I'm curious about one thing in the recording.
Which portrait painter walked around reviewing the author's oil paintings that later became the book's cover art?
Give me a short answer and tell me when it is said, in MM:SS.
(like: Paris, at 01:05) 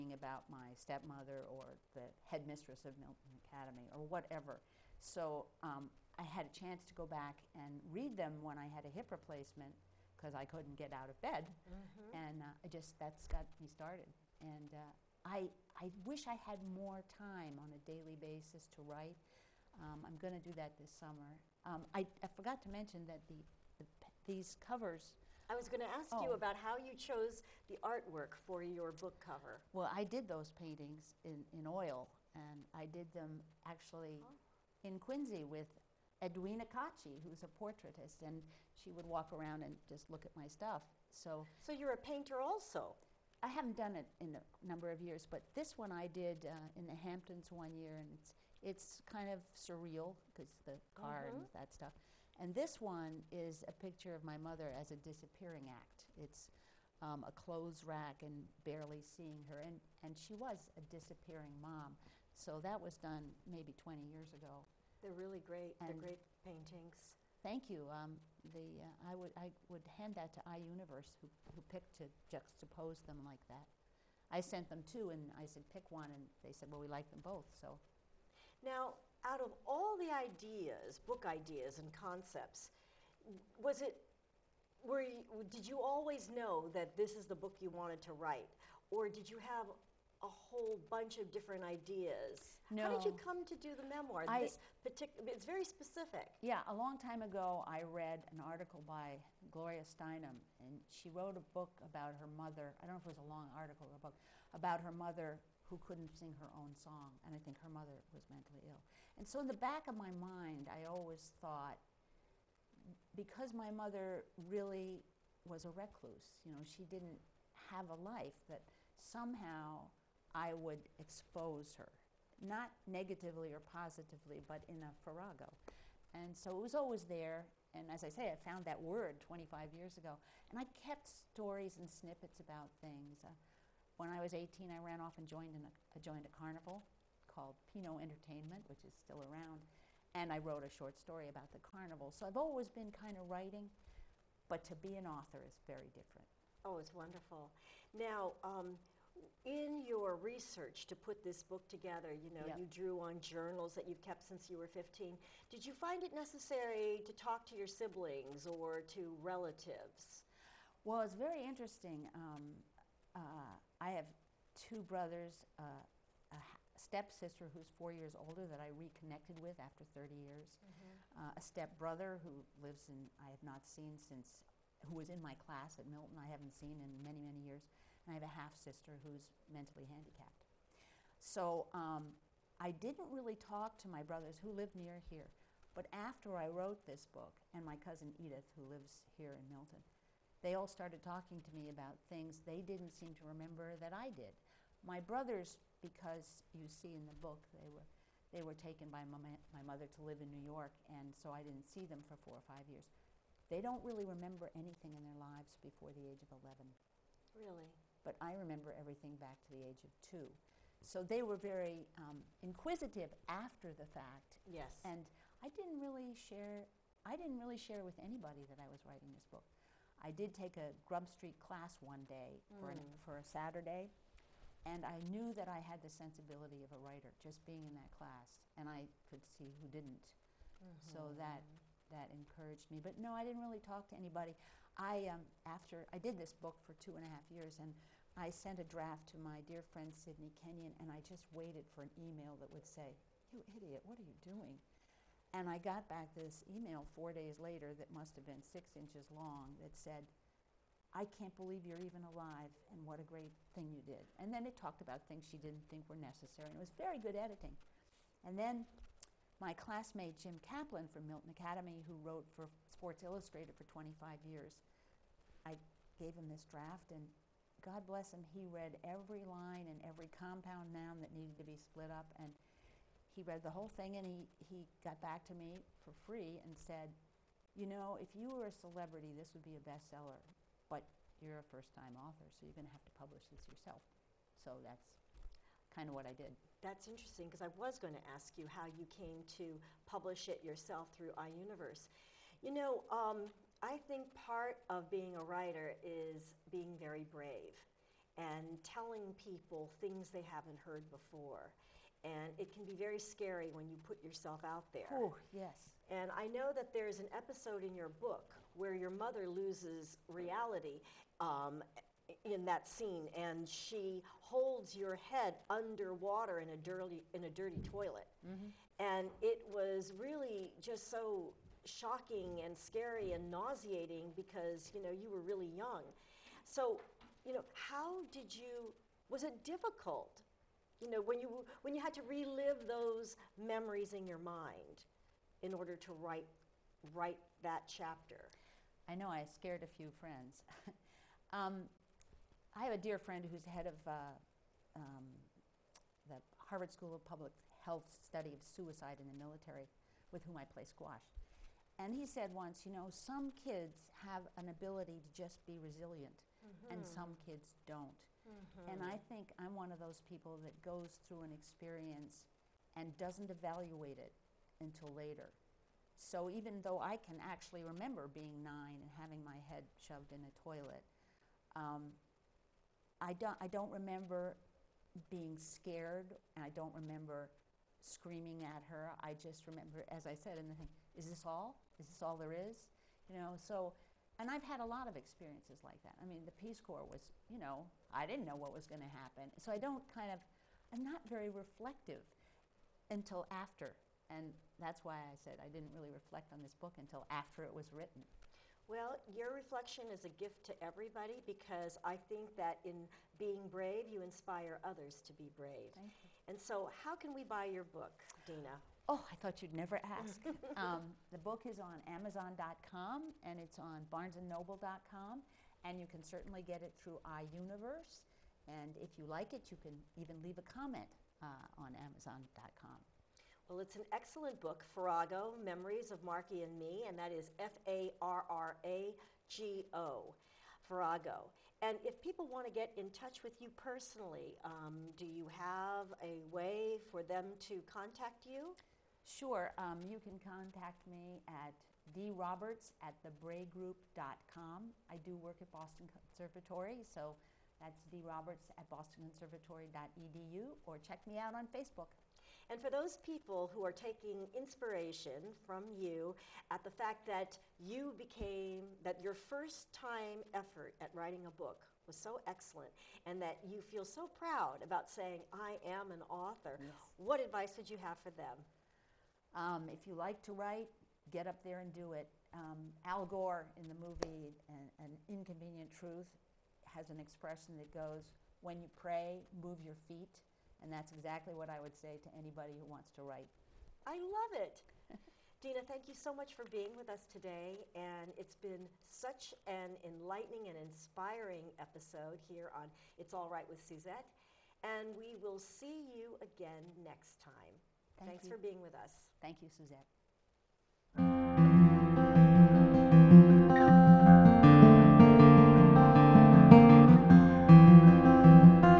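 Edwina Cacci, at 00:36.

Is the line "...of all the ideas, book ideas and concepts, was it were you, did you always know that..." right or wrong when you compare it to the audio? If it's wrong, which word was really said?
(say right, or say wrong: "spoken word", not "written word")
right.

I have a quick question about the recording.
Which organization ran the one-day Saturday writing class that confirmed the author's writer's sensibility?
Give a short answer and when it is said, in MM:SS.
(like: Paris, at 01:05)
Grub Street, at 03:40.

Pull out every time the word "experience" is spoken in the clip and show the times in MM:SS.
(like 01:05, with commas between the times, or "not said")
06:01, 06:24.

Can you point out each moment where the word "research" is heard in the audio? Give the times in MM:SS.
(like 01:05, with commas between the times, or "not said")
02:30.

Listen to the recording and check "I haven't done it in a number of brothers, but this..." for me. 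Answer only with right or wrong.
wrong.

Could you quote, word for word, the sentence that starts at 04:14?
And then it talked about things she didn't think were necessary, and it was very good editing.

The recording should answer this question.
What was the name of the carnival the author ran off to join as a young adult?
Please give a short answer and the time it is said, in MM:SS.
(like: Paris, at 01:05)
Pinot Entertainment, at 02:17.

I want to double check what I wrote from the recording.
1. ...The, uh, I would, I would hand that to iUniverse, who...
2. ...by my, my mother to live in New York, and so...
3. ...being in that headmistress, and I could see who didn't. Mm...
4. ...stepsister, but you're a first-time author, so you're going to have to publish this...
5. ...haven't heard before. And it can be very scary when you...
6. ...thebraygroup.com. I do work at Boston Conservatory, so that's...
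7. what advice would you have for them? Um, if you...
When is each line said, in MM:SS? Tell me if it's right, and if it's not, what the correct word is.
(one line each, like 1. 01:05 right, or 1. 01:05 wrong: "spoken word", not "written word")
1. 01:08 right
2. 03:18 right
3. 03:47 wrong: "class", not "headmistress"
4. 04:39 wrong: "bestseller", not "stepsister"
5. 05:00 right
6. 07:23 right
7. 07:46 right.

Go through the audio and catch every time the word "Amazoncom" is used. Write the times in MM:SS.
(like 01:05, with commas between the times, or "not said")
06:51, 07:01.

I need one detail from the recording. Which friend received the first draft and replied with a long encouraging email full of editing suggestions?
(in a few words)
Sidney Kenyon.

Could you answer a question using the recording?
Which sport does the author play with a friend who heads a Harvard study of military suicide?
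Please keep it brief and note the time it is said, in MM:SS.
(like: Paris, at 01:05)
Squash, at 05:50.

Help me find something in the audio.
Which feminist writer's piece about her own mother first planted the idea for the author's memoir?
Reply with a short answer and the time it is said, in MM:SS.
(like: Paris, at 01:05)
Gloria Steinem, at 01:39.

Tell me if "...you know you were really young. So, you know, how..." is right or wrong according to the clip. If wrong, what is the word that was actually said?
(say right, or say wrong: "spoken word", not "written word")
right.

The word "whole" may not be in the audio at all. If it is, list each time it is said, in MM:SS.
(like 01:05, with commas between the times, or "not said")
01:30, 04:33.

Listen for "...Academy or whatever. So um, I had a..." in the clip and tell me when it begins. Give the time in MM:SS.
00:03.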